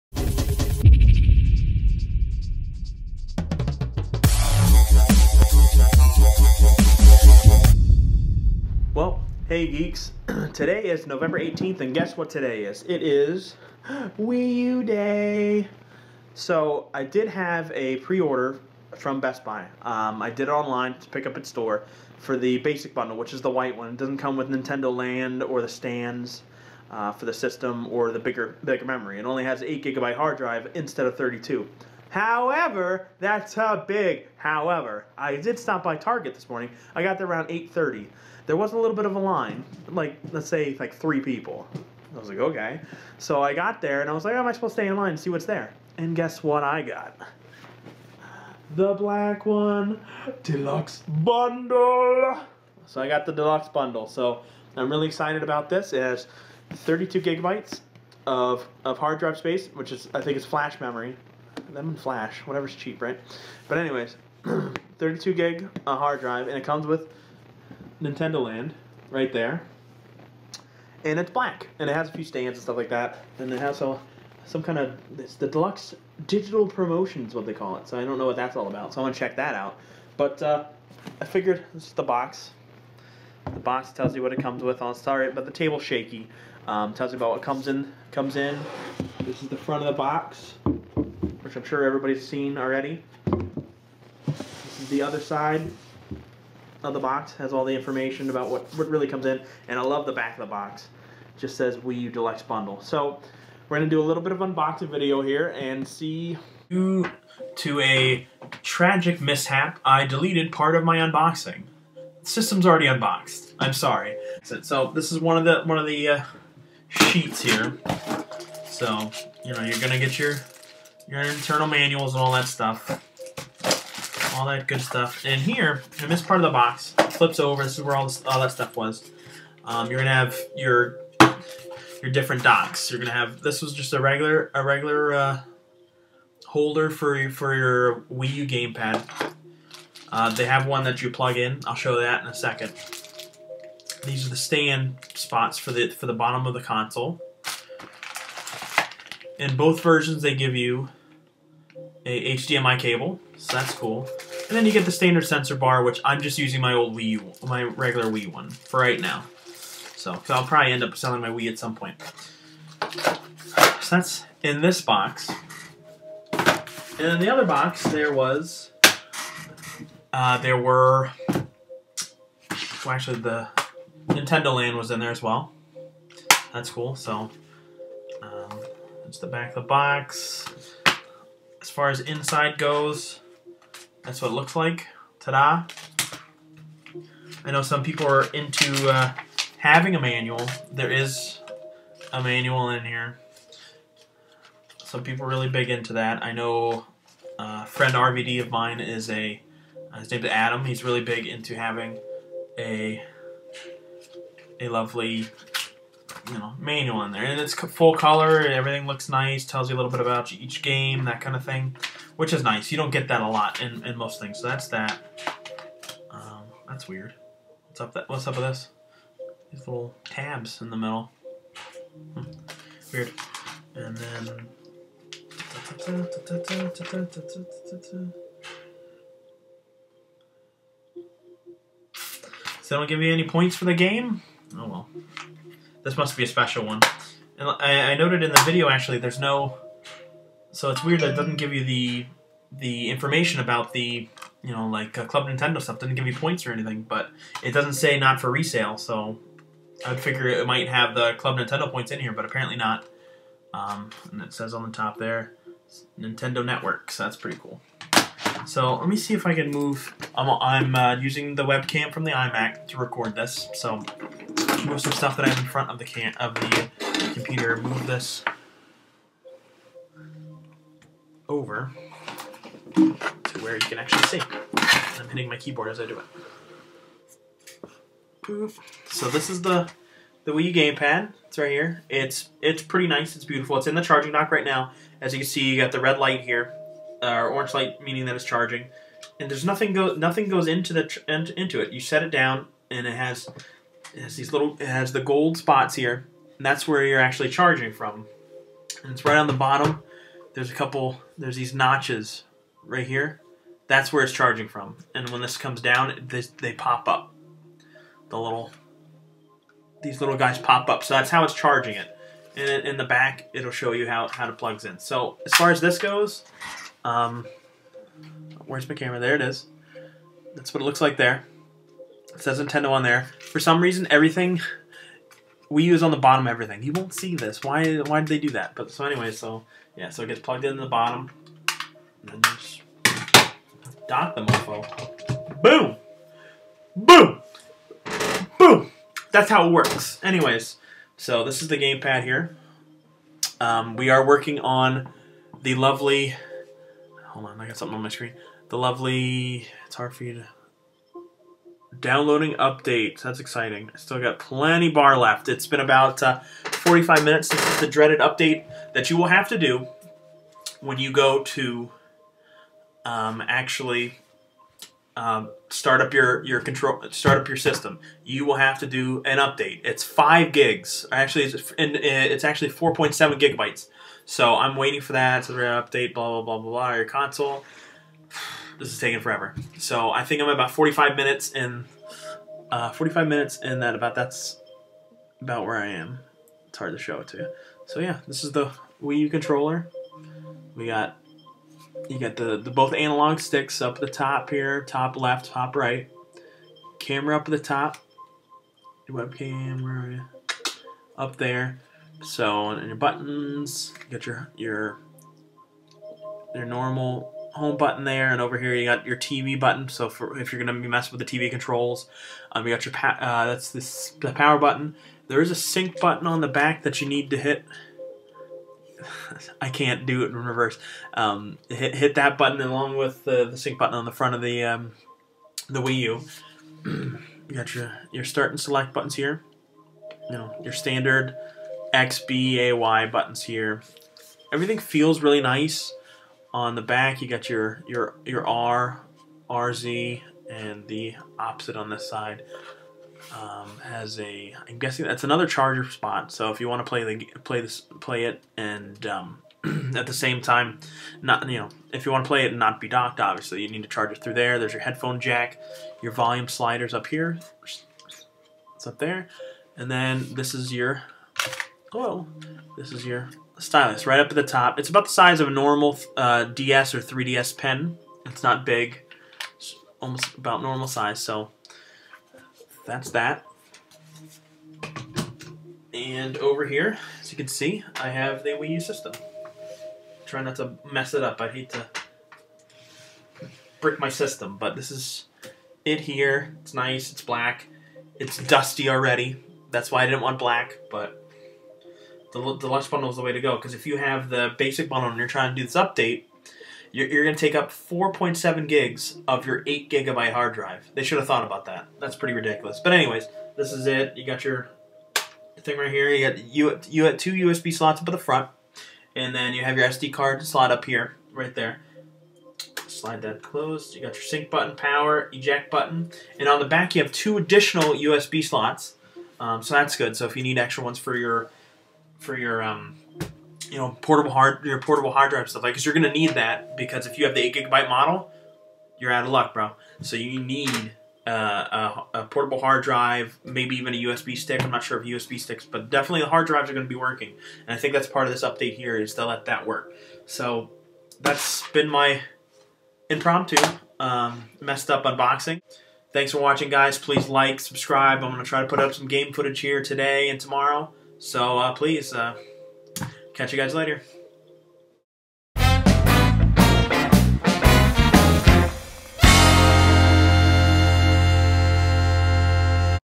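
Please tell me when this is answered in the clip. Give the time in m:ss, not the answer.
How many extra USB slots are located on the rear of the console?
8:36.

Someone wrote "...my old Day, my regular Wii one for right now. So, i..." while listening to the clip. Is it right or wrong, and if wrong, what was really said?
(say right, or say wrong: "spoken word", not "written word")
wrong: "Wii", not "Day".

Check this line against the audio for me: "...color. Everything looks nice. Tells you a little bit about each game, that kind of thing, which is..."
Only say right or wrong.
right.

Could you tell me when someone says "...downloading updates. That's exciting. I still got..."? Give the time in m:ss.
5:51.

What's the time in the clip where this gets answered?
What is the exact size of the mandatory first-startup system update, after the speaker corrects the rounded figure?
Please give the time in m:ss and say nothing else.
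6:12.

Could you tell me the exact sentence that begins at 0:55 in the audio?
It has 32 gigabytes of, of hard drive space, which is, I think is flash memory them and flash, whatever's cheap, right?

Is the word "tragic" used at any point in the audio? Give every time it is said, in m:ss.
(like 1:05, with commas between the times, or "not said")
1:48.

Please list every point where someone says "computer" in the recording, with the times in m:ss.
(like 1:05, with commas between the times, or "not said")
4:27.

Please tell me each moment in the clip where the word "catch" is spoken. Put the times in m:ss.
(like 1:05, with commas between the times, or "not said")
9:13.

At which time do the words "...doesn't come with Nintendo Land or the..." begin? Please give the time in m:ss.
0:23.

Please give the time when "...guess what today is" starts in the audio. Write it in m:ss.
0:11.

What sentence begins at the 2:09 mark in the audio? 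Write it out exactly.
Um, you're gonna have your your different docks.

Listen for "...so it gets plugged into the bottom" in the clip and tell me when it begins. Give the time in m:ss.
5:29.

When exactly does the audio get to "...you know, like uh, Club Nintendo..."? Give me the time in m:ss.
4:04.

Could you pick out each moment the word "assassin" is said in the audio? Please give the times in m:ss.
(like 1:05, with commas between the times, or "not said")
not said.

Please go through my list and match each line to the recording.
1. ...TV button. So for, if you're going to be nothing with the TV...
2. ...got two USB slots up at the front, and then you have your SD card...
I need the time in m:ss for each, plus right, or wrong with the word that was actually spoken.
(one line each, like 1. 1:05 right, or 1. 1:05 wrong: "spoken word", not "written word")
1. 6:48 wrong: "messing", not "nothing"
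2. 8:26 right.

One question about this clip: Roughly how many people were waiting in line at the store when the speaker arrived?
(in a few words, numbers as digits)
3.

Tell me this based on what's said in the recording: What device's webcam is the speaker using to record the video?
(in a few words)
iMac.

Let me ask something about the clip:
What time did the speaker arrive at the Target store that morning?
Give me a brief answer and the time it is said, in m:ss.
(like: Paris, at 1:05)
8:30, at 0:37.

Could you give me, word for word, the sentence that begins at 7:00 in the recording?
Um, hit, hit that button along with the, the sync button on the front of the um, the Wii U.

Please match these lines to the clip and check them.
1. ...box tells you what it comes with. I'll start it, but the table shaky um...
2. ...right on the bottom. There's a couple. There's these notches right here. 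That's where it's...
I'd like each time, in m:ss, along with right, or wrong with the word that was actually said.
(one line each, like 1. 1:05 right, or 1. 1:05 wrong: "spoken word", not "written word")
1. 1:23 right
2. 4:59 right.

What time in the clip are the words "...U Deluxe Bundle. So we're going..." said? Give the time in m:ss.
1:42.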